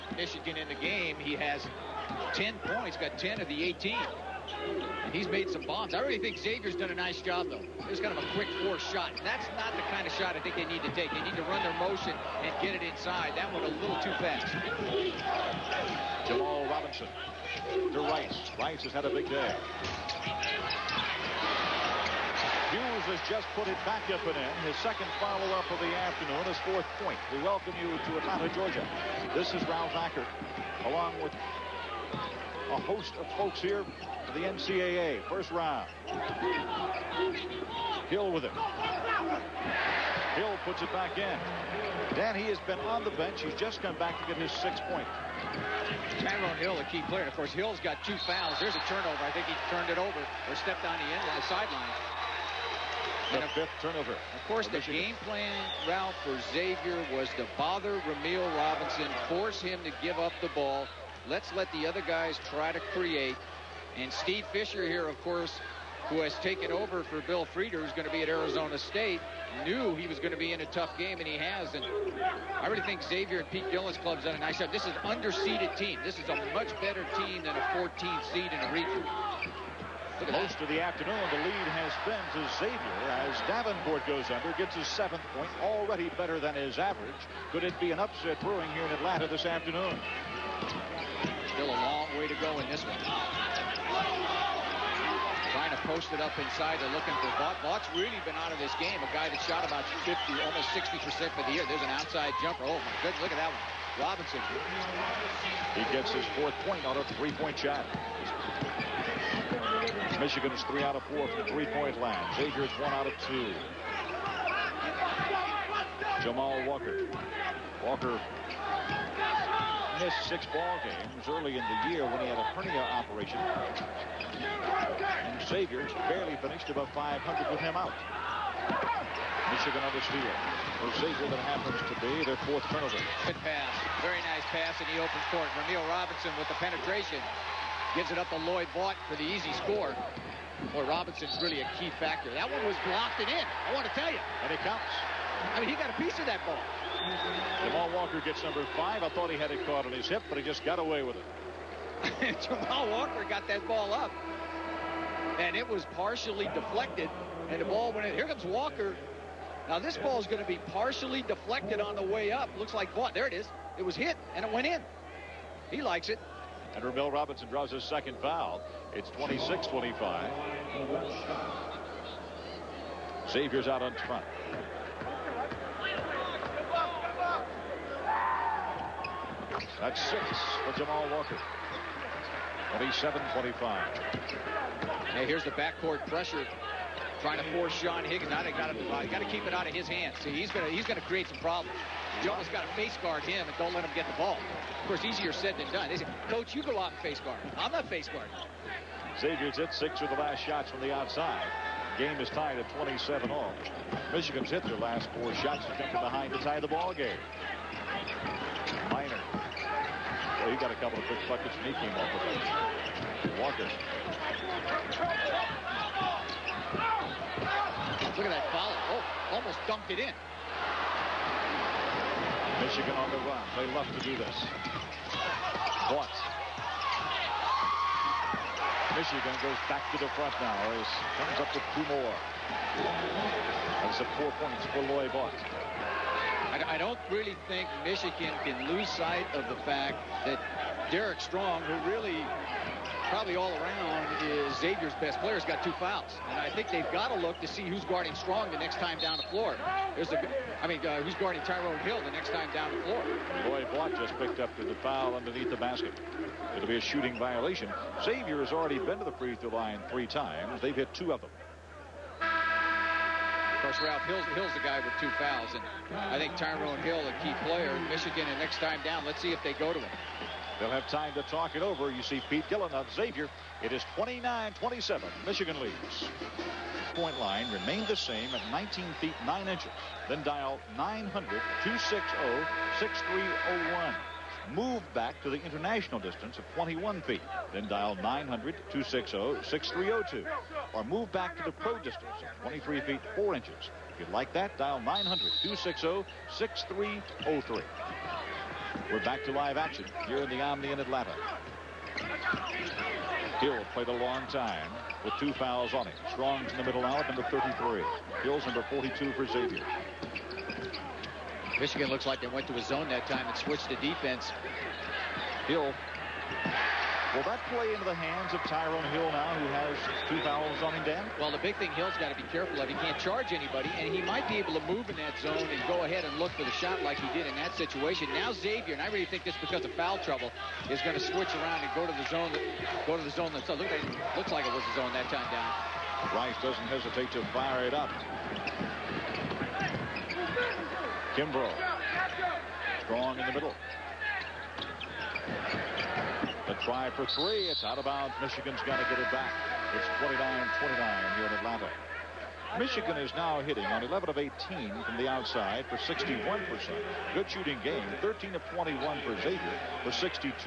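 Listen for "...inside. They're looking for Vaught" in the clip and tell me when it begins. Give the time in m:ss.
1:36.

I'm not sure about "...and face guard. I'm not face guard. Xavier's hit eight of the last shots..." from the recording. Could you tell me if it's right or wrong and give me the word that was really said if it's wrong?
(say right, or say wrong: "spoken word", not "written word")
wrong: "six", not "eight".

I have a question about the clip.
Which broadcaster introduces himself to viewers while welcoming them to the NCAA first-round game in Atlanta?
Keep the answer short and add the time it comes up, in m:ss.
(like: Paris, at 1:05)
Ralph Hacker, at 0:29.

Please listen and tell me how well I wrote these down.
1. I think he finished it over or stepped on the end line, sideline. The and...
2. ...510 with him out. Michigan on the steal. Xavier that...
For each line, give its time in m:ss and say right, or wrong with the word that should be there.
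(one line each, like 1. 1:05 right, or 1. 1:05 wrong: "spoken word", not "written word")
1. 0:49 wrong: "turned", not "finished"
2. 2:06 wrong: "500", not "510".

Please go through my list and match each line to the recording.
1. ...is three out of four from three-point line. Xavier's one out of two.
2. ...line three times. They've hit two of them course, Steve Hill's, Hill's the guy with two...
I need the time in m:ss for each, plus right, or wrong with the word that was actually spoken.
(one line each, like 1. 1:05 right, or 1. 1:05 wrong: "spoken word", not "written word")
1. 1:50 right
2. 4:19 wrong: "Ralph", not "Steve".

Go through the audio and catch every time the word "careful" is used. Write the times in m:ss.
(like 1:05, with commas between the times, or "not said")
5:22.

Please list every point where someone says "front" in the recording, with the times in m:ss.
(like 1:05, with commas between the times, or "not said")
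2:54, 3:50.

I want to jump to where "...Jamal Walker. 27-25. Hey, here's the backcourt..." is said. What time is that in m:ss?
3:00.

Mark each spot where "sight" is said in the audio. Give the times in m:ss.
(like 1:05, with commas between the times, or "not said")
3:58.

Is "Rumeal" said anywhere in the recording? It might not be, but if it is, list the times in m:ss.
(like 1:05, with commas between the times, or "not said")
0:58, 2:15, 2:46.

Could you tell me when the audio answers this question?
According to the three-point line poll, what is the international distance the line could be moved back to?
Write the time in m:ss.
4:46.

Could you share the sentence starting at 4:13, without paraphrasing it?
Boy, Vaught just picked up the foul underneath the basket.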